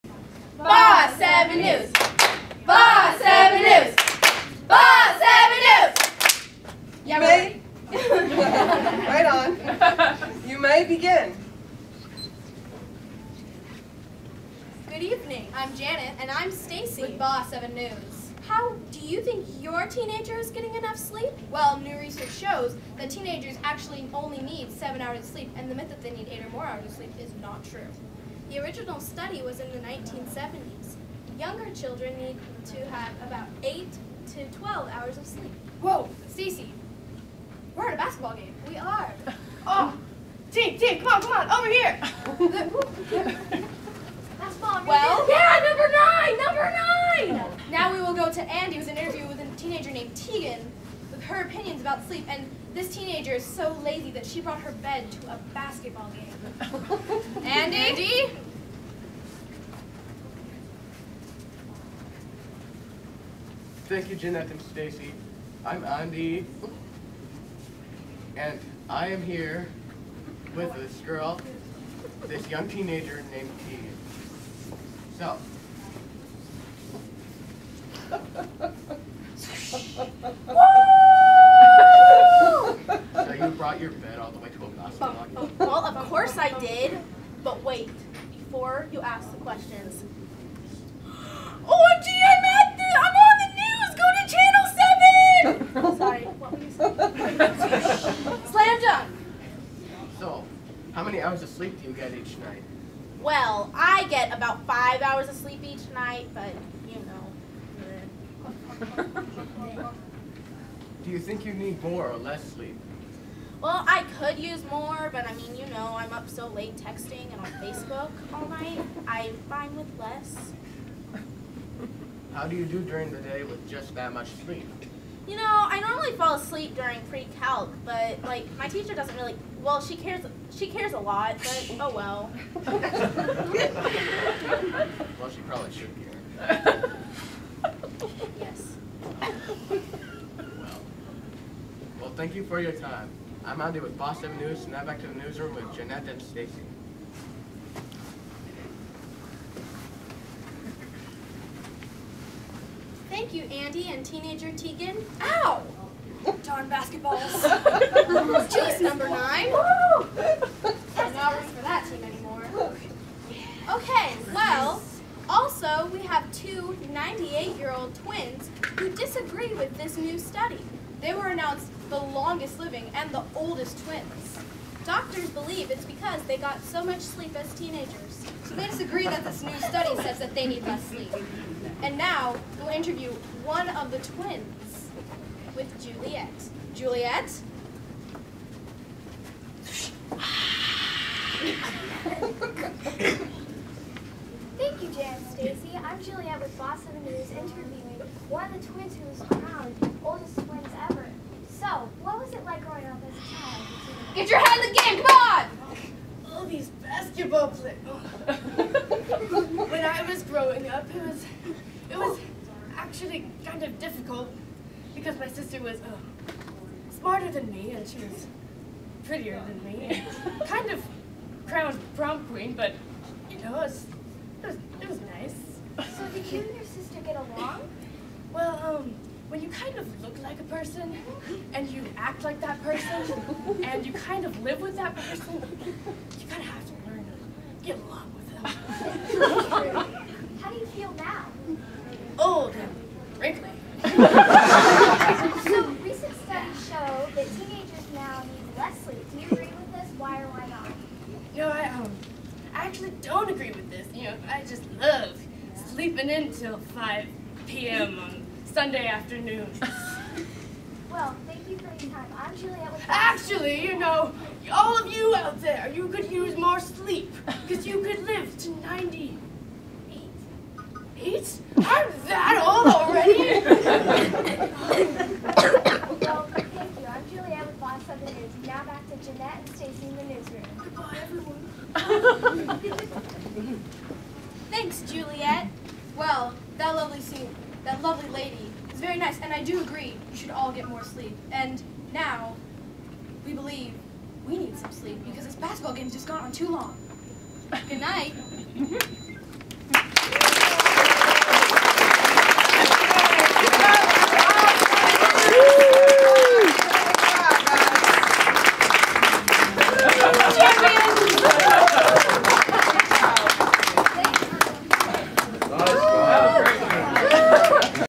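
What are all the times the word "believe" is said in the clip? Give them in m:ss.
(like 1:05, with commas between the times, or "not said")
2:55, 4:53.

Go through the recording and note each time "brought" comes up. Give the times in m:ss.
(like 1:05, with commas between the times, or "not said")
0:54, 1:23.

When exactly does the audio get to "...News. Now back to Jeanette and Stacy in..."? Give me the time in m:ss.
4:38.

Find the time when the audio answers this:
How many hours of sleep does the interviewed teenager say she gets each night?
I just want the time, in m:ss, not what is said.
1:44.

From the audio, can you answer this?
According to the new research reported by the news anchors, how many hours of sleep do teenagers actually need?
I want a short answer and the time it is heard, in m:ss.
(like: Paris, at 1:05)
7 hours, at 0:24.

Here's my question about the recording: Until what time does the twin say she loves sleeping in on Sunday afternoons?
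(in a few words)
5 p.m.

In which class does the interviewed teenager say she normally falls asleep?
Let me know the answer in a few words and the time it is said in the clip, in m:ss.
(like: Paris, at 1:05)
Pre-calc, at 2:07.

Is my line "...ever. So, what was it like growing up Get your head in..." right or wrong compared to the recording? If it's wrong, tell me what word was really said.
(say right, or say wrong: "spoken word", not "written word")
right.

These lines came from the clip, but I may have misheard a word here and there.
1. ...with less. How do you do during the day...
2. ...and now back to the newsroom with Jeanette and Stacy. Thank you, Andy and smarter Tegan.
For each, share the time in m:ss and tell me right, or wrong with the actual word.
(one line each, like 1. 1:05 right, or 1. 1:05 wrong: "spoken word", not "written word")
1. 1:59 right
2. 2:24 wrong: "teenager", not "smarter".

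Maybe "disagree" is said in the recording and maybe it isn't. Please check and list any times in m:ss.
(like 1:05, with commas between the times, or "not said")
2:48, 2:58.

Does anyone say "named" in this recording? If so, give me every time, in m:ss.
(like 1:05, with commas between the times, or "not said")
0:49, 1:13.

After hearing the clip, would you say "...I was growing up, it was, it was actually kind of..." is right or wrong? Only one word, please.
right.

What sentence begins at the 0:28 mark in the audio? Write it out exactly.
The original study was in the 1970s.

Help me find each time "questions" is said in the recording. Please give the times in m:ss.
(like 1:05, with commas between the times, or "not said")
1:29.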